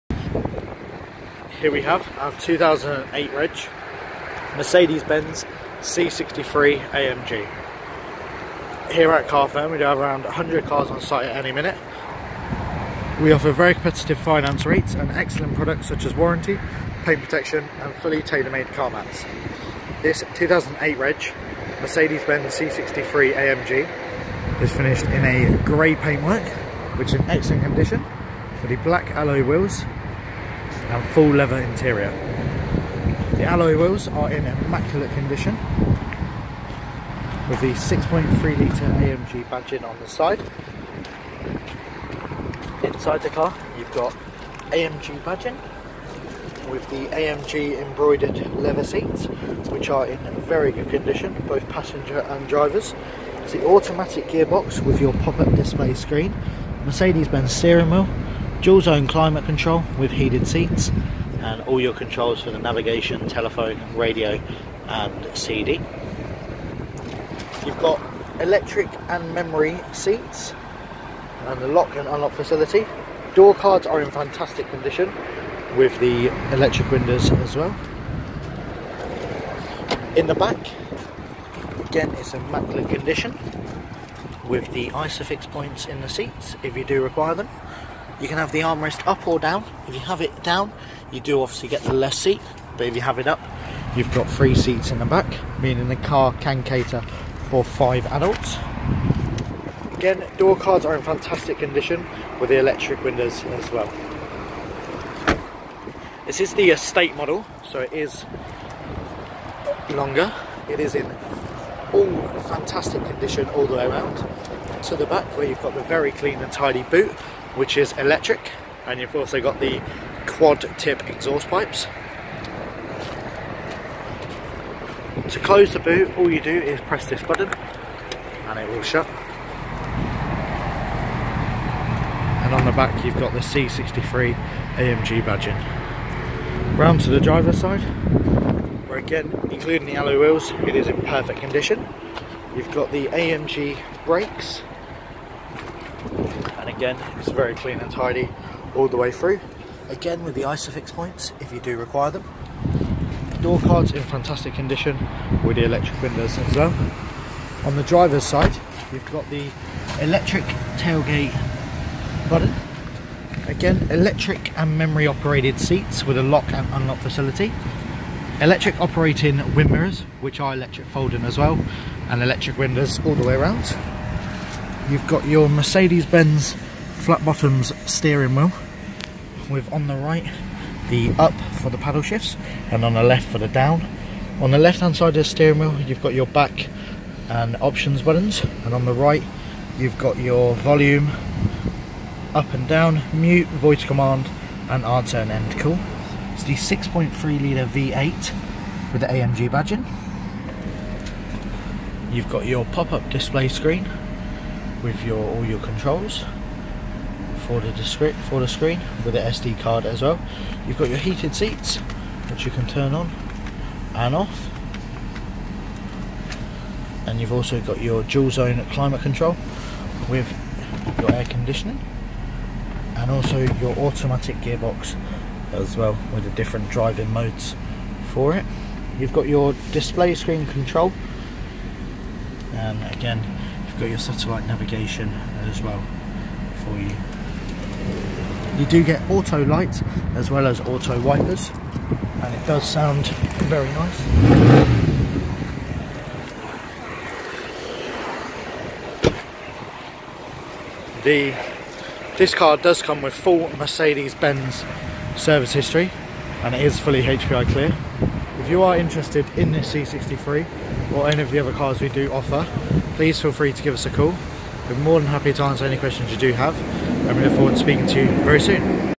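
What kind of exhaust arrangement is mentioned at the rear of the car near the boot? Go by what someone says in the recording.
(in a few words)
quad tip.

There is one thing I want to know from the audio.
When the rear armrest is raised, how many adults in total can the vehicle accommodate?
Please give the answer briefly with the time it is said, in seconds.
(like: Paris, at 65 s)
5, at 97 s.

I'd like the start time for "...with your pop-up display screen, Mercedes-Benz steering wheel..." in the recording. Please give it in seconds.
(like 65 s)
54 s.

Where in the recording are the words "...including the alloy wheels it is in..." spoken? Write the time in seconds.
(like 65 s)
139 s.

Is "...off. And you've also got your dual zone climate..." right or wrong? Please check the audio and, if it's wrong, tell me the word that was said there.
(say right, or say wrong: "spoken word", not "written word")
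right.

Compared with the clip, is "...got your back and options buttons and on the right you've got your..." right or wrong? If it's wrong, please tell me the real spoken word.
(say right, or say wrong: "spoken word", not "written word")
right.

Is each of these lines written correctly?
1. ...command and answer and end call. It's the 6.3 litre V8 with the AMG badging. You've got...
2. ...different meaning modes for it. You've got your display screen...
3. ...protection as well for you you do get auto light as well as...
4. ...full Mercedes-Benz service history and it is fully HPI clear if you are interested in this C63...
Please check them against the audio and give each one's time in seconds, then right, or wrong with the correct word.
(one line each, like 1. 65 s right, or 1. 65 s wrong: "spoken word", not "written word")
1. 193 s right
2. 226 s wrong: "driving", not "meaning"
3. 234 s wrong: "navigation", not "protection"
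4. 253 s right.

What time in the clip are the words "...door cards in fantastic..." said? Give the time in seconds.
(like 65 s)
153 s.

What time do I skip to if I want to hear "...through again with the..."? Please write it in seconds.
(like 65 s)
149 s.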